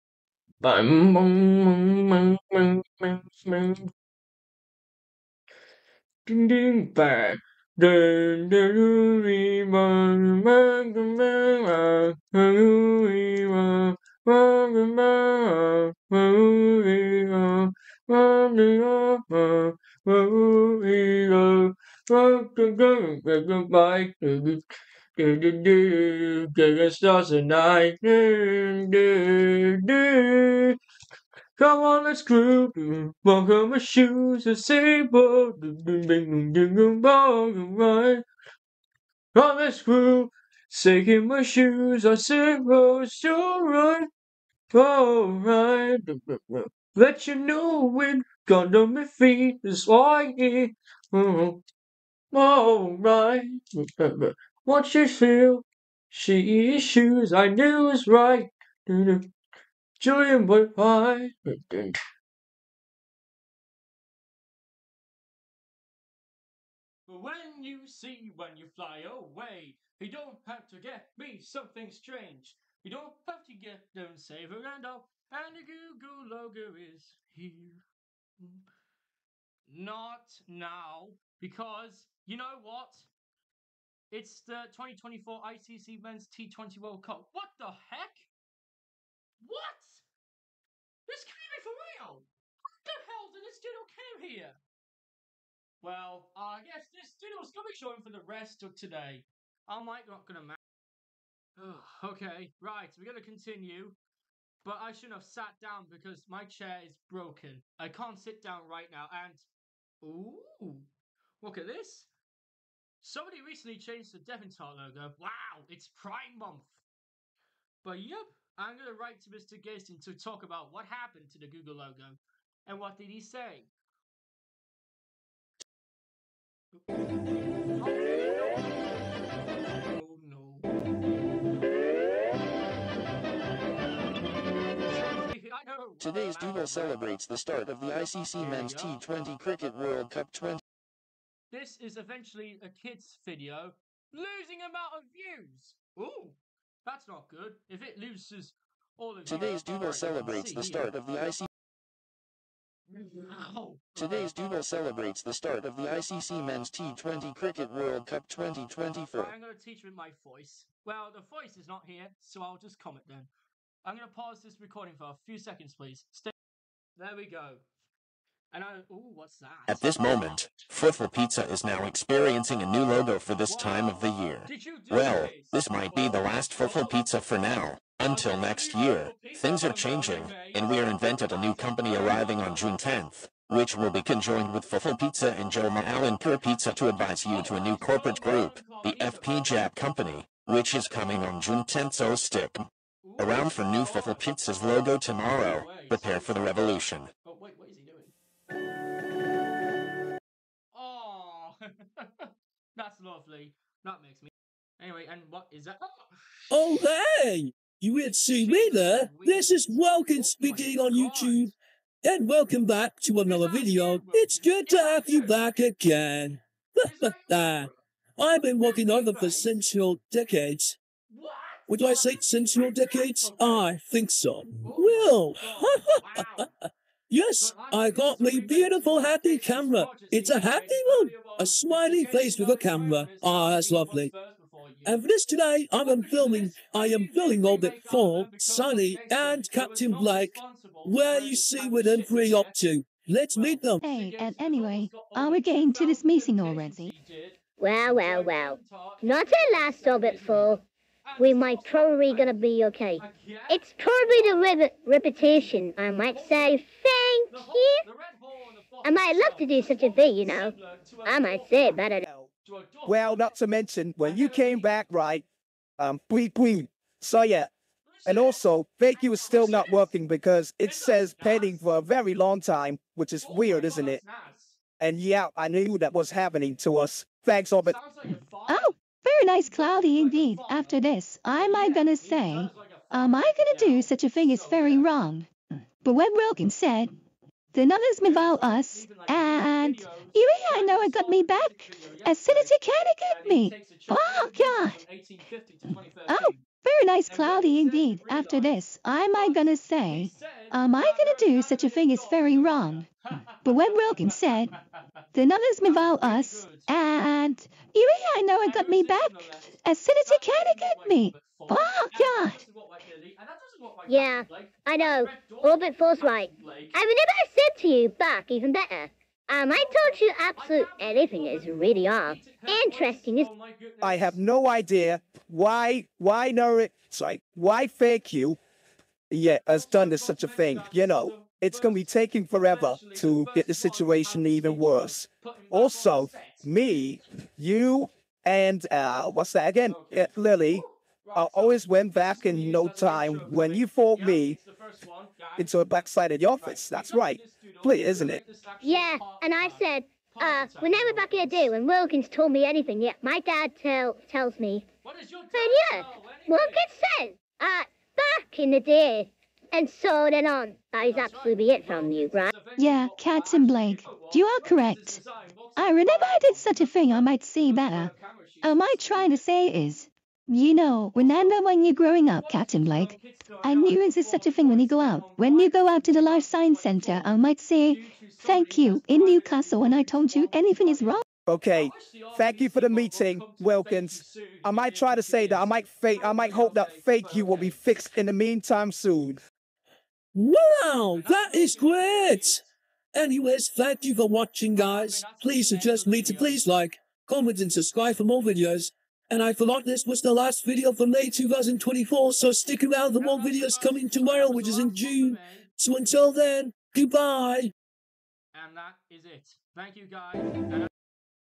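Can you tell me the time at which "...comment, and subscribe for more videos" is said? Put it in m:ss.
6:37.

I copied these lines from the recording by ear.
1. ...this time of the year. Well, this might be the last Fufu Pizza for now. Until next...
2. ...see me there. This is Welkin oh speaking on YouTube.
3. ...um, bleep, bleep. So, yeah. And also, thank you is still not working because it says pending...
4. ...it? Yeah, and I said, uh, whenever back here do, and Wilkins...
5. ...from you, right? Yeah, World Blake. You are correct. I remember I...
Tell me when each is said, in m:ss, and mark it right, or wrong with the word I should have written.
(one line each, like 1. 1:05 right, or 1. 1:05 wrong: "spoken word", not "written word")
1. 2:53 right
2. 3:28 right
3. 4:25 right
4. 5:48 right
5. 6:01 wrong: "Captain", not "World".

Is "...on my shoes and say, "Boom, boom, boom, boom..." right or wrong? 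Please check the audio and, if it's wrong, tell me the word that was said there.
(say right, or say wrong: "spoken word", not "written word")
right.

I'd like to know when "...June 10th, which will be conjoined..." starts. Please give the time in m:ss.
3:02.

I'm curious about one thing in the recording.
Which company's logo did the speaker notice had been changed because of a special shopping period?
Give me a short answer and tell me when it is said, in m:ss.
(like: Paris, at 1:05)
Devontar, at 1:54.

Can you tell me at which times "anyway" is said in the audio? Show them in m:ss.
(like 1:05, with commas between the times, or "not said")
3:24, 4:04, 6:32.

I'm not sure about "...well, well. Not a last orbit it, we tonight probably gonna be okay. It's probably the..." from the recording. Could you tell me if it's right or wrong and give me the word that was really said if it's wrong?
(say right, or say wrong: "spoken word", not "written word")
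wrong: "might", not "tonight".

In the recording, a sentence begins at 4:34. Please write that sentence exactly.
And yeah, I knew that was happening to us.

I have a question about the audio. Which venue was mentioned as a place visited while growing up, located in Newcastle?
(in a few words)
Life Science Center.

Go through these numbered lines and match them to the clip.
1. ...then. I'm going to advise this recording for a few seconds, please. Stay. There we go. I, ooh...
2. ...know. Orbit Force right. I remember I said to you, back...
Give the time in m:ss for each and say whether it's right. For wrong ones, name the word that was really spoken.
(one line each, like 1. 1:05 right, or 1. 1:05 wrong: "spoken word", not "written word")
1. 2:43 wrong: "pause", not "advise"
2. 5:14 right.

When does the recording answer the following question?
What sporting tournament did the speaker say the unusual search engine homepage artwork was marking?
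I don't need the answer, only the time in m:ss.
1:25.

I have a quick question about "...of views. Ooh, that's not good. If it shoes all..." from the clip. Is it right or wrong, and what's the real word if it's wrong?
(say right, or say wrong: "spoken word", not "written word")
wrong: "loses", not "shoes".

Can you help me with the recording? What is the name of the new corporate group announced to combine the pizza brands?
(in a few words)
FP Jap Company.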